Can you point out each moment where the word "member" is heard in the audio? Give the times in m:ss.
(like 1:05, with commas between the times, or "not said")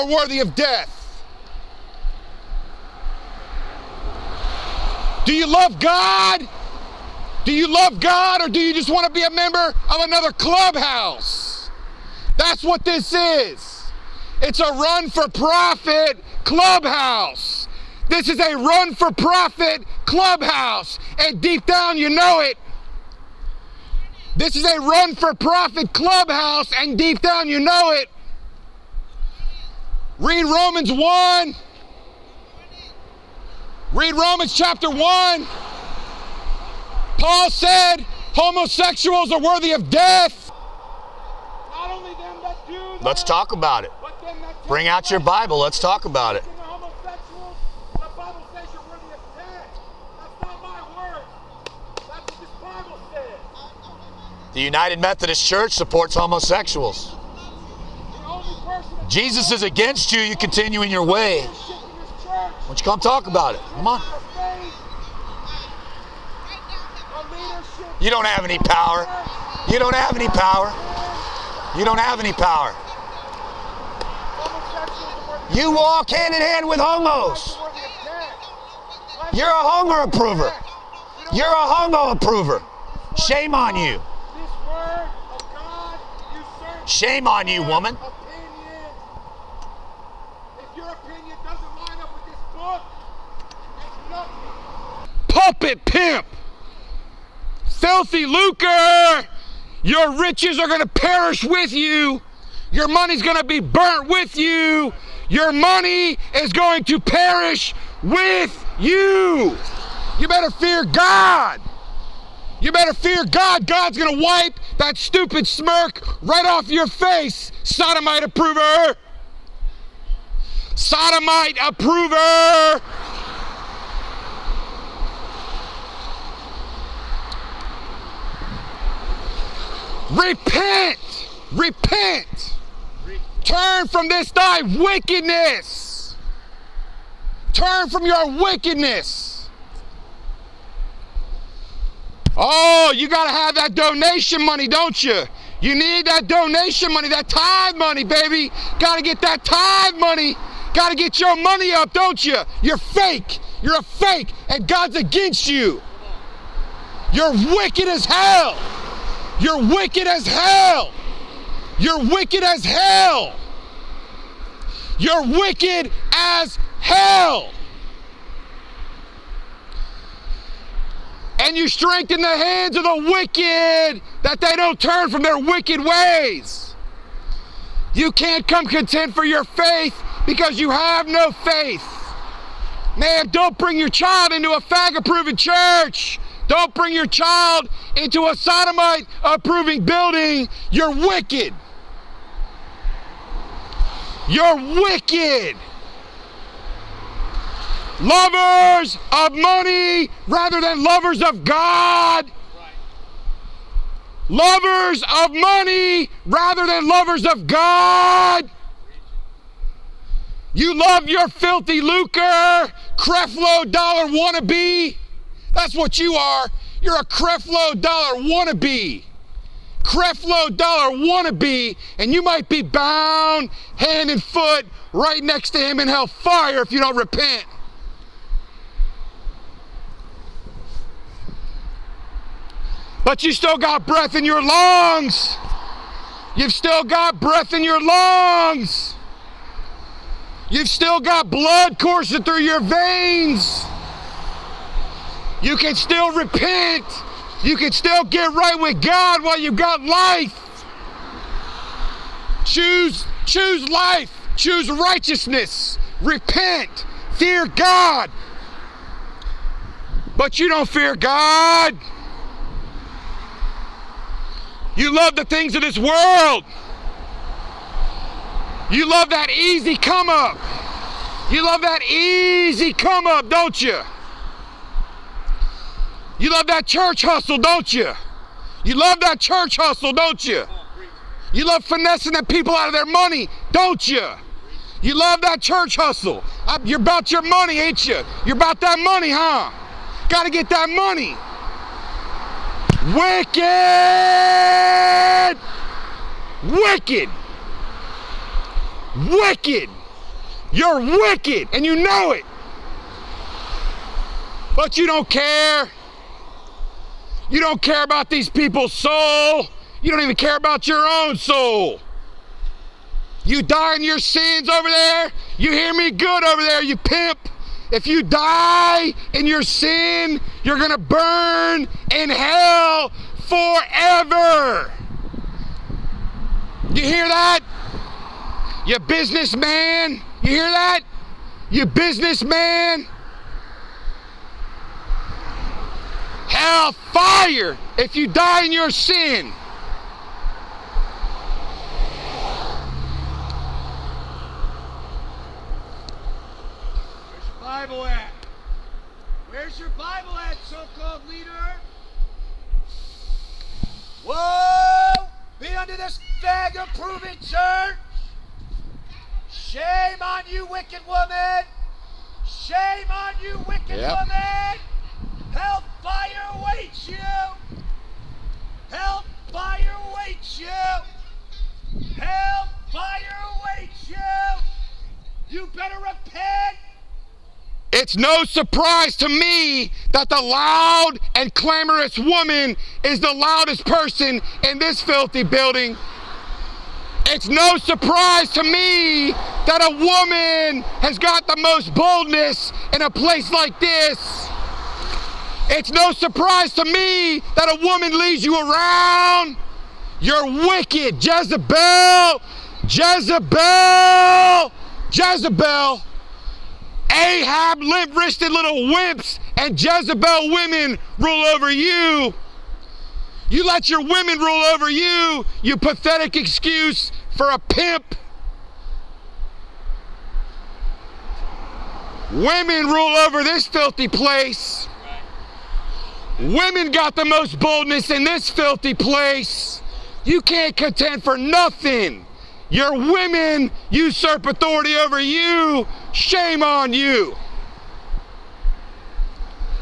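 0:09.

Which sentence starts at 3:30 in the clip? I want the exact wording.
You love your filthy lucre, Creflo Dollar wannabe.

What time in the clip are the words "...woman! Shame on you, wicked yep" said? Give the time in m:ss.
6:00.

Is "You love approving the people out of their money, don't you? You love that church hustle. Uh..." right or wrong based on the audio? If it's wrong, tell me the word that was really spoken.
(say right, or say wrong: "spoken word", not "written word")
wrong: "finessing", not "approving".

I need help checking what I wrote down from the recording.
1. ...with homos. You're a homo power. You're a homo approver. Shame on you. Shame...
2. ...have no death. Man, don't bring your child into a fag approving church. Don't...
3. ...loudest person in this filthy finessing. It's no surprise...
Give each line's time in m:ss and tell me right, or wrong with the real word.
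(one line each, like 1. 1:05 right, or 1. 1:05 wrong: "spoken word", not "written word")
1. 1:16 wrong: "approver", not "power"
2. 3:00 wrong: "faith", not "death"
3. 6:23 wrong: "building", not "finessing".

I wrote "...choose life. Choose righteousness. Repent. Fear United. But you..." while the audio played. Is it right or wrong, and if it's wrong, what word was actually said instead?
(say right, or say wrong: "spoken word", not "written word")
wrong: "God", not "United".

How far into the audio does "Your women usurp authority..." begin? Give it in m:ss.
7:12.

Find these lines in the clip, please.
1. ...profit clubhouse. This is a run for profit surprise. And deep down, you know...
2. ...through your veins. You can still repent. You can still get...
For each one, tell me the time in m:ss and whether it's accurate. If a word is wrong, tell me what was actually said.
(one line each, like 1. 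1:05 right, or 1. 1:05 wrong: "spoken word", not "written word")
1. 0:15 wrong: "clubhouse", not "surprise"
2. 4:02 right.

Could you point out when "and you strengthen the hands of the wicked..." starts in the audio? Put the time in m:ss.
2:51.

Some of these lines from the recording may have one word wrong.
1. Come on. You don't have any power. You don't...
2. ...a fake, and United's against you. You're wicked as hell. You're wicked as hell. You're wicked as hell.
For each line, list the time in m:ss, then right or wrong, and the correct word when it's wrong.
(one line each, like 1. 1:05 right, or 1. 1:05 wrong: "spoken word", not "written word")
1. 1:03 right
2. 2:33 wrong: "God", not "United".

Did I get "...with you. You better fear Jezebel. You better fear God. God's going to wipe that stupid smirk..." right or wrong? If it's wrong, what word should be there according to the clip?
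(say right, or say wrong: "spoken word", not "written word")
wrong: "God", not "Jezebel".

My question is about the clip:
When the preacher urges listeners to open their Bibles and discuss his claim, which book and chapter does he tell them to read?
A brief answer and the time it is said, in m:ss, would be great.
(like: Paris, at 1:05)
Romans chapter 1, at 0:34.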